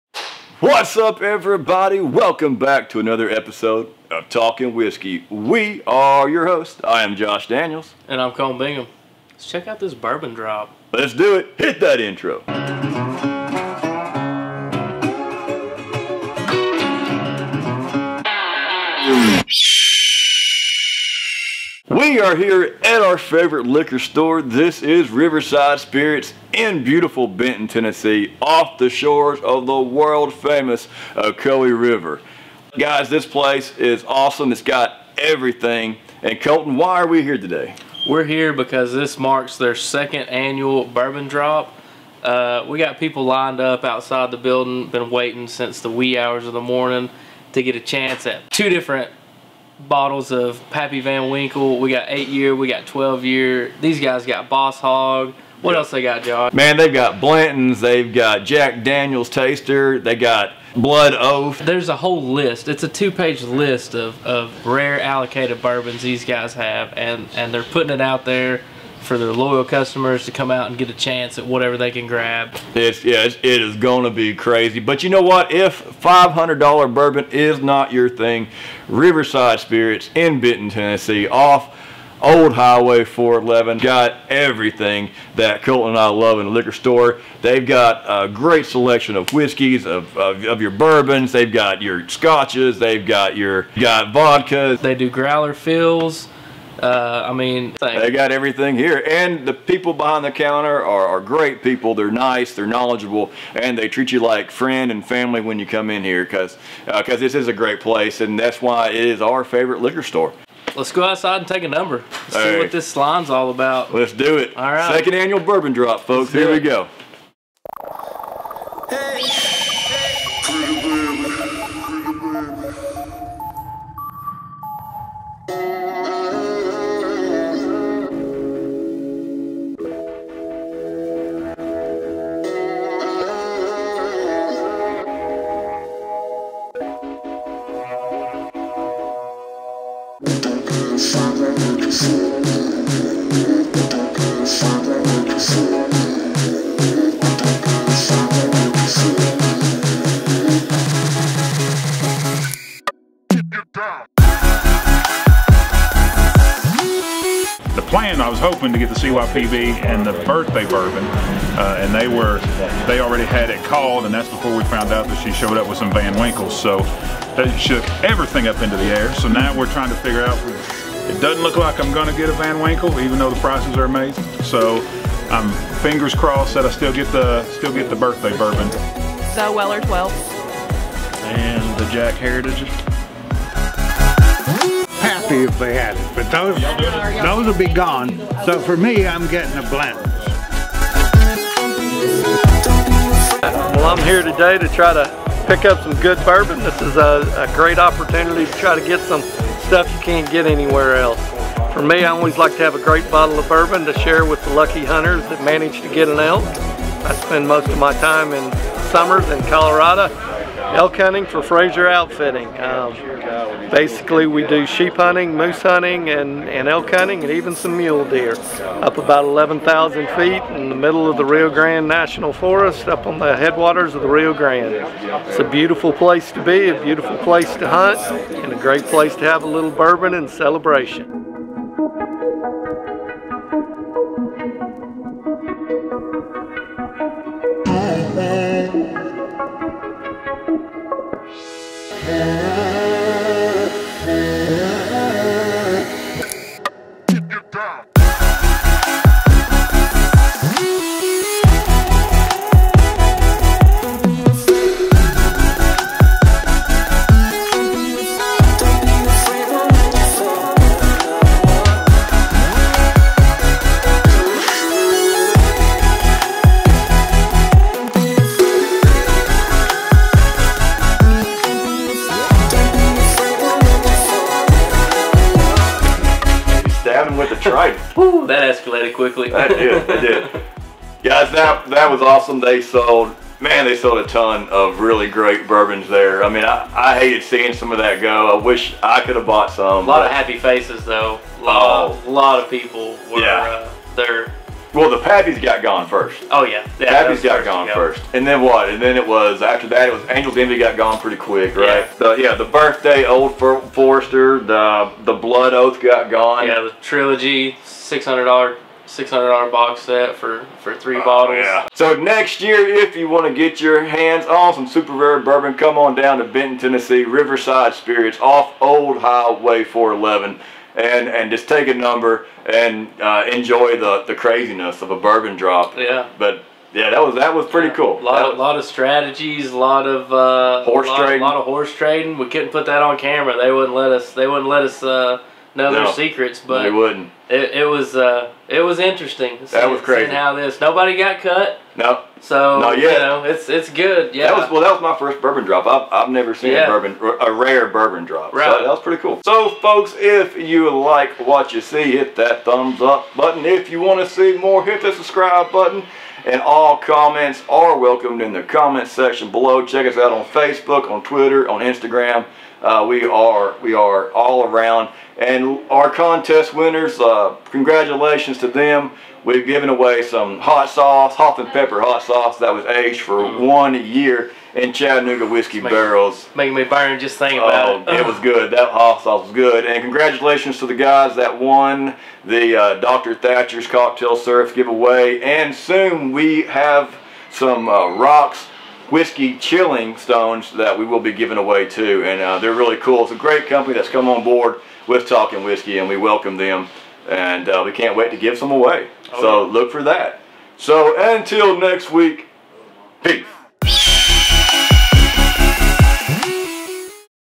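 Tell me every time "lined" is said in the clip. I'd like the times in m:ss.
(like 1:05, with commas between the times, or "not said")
0:43.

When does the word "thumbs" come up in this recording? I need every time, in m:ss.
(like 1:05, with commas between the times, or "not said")
5:52.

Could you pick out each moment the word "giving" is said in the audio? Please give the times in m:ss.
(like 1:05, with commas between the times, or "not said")
6:31.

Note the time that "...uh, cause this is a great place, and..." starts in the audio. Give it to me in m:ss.
1:46.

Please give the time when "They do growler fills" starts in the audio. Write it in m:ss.
1:34.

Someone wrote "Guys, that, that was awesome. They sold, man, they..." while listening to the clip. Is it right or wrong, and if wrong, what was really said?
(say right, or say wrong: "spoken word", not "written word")
right.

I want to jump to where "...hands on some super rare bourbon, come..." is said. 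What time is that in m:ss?
5:13.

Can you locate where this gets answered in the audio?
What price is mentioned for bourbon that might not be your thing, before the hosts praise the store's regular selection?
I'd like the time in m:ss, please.
1:16.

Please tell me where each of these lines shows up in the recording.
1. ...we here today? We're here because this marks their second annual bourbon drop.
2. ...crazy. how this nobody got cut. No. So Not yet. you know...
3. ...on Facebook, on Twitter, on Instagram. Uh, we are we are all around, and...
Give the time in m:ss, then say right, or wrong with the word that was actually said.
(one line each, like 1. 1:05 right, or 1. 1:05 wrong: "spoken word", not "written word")
1. 0:37 right
2. 5:39 right
3. 6:00 right.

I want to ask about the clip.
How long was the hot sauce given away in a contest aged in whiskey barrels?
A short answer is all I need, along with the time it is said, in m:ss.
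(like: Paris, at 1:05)
1 year, at 6:13.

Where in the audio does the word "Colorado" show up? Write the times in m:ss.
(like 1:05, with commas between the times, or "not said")
3:29.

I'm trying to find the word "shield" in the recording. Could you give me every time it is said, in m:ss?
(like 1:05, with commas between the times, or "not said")
not said.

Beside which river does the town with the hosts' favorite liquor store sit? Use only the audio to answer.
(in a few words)
Ocoee River.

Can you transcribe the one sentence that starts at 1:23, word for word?
Got everything that Colten and I love in a liquor store.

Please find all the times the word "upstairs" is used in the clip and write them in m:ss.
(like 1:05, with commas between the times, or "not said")
not said.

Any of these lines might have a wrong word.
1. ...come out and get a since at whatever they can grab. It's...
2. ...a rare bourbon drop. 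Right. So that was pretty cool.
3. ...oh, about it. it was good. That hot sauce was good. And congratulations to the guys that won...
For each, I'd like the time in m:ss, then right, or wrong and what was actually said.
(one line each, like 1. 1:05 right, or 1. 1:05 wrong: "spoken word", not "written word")
1. 1:10 wrong: "chance", not "since"
2. 5:47 right
3. 6:17 right.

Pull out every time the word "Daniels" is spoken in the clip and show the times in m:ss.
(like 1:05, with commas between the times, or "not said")
0:07, 0:58.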